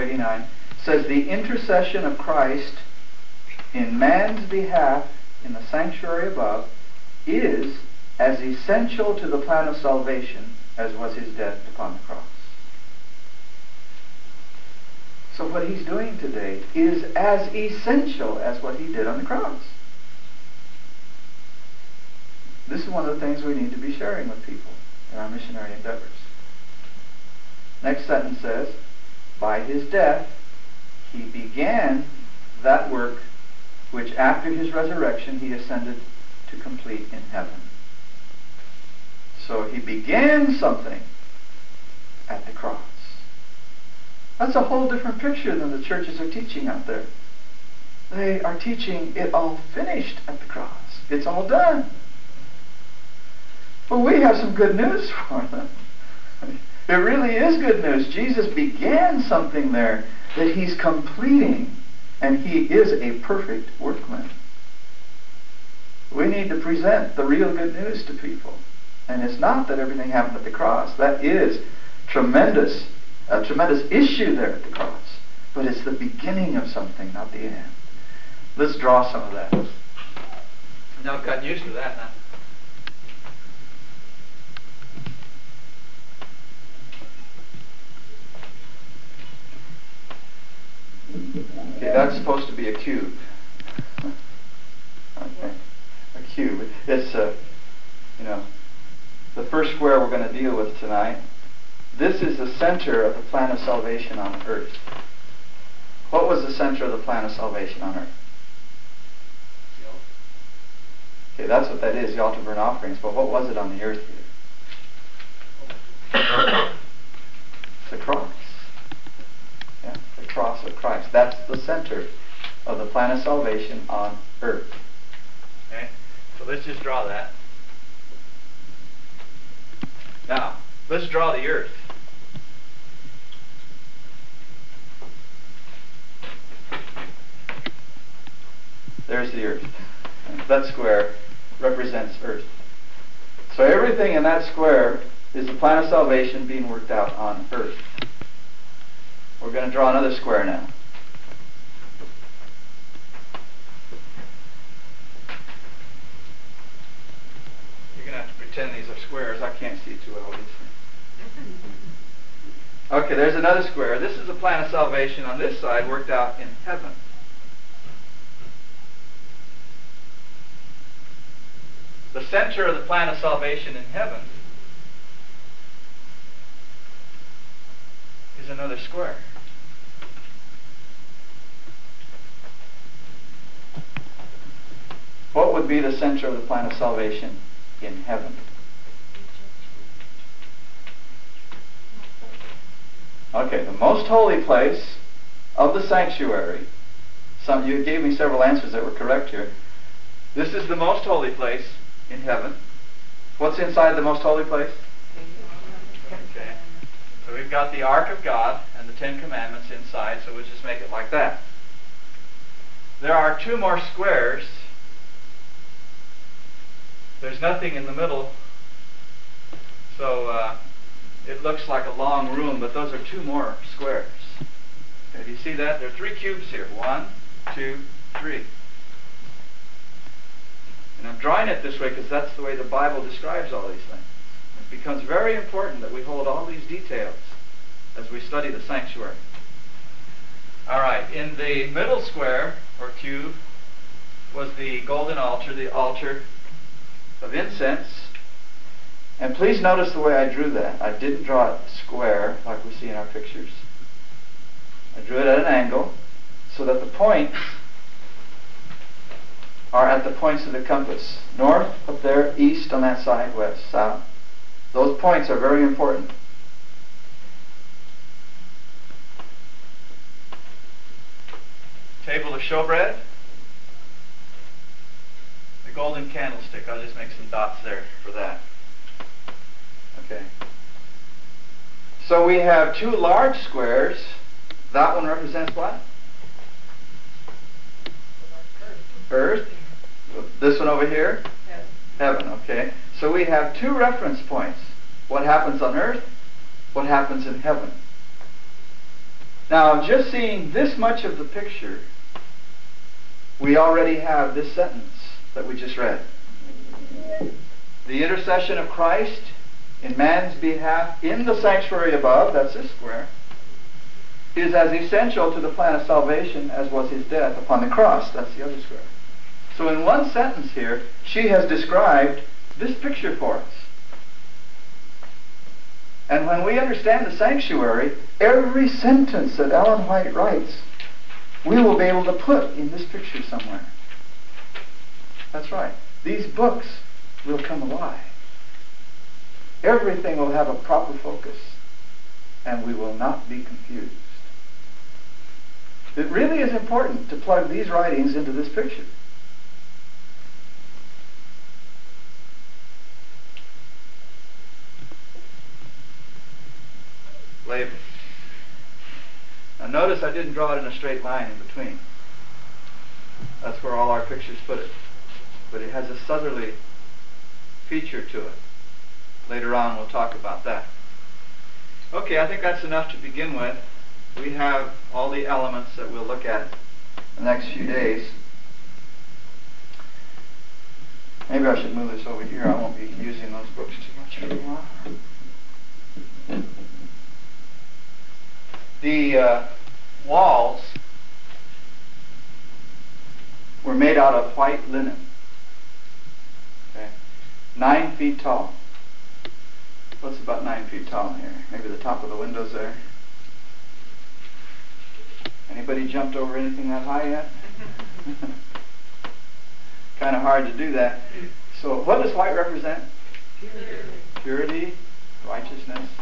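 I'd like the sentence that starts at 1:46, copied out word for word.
What was the center of the plan of salvation on earth?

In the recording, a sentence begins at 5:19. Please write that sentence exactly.
So in one sentence here, she has described this picture for us.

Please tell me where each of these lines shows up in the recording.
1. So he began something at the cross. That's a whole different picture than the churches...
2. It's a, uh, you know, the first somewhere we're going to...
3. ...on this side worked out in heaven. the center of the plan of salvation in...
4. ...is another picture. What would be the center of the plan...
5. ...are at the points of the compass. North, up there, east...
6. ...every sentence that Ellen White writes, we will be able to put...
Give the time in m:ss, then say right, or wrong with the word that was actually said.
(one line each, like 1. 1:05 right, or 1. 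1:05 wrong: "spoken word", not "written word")
1. 0:39 right
2. 1:36 wrong: "square", not "somewhere"
3. 2:45 right
4. 2:58 wrong: "square", not "picture"
5. 4:19 right
6. 5:28 right.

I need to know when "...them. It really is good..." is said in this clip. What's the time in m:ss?
0:55.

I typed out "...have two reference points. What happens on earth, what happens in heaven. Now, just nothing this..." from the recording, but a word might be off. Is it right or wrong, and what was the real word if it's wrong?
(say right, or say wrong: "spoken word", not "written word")
wrong: "seeing", not "nothing".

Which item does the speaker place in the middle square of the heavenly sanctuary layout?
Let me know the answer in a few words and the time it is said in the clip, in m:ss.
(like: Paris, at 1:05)
Altar of incense, at 4:05.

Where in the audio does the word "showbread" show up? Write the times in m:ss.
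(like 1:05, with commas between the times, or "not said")
4:32.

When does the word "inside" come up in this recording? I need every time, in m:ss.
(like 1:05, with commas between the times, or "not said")
3:23, 3:29.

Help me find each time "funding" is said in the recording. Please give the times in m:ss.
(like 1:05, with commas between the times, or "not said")
not said.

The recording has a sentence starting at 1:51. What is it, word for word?
Okay, that's what that is, the altar burnt offerings.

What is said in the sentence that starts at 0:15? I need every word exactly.
So what he's doing today is as essential as what he did on the cross.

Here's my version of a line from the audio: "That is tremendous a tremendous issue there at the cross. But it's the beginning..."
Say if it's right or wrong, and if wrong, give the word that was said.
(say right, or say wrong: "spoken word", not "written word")
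right.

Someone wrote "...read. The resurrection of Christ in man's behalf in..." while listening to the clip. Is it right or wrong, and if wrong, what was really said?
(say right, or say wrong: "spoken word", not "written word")
wrong: "intercession", not "resurrection".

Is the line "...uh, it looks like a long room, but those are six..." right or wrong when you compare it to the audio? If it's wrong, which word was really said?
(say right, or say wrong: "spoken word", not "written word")
wrong: "two", not "six".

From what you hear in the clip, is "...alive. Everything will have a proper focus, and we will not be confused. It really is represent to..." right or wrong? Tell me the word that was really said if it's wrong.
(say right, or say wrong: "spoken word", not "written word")
wrong: "important", not "represent".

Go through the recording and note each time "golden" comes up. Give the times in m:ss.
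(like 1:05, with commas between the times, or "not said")
4:04, 4:35.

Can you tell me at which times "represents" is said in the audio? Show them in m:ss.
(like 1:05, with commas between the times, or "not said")
2:21, 4:45, 6:52.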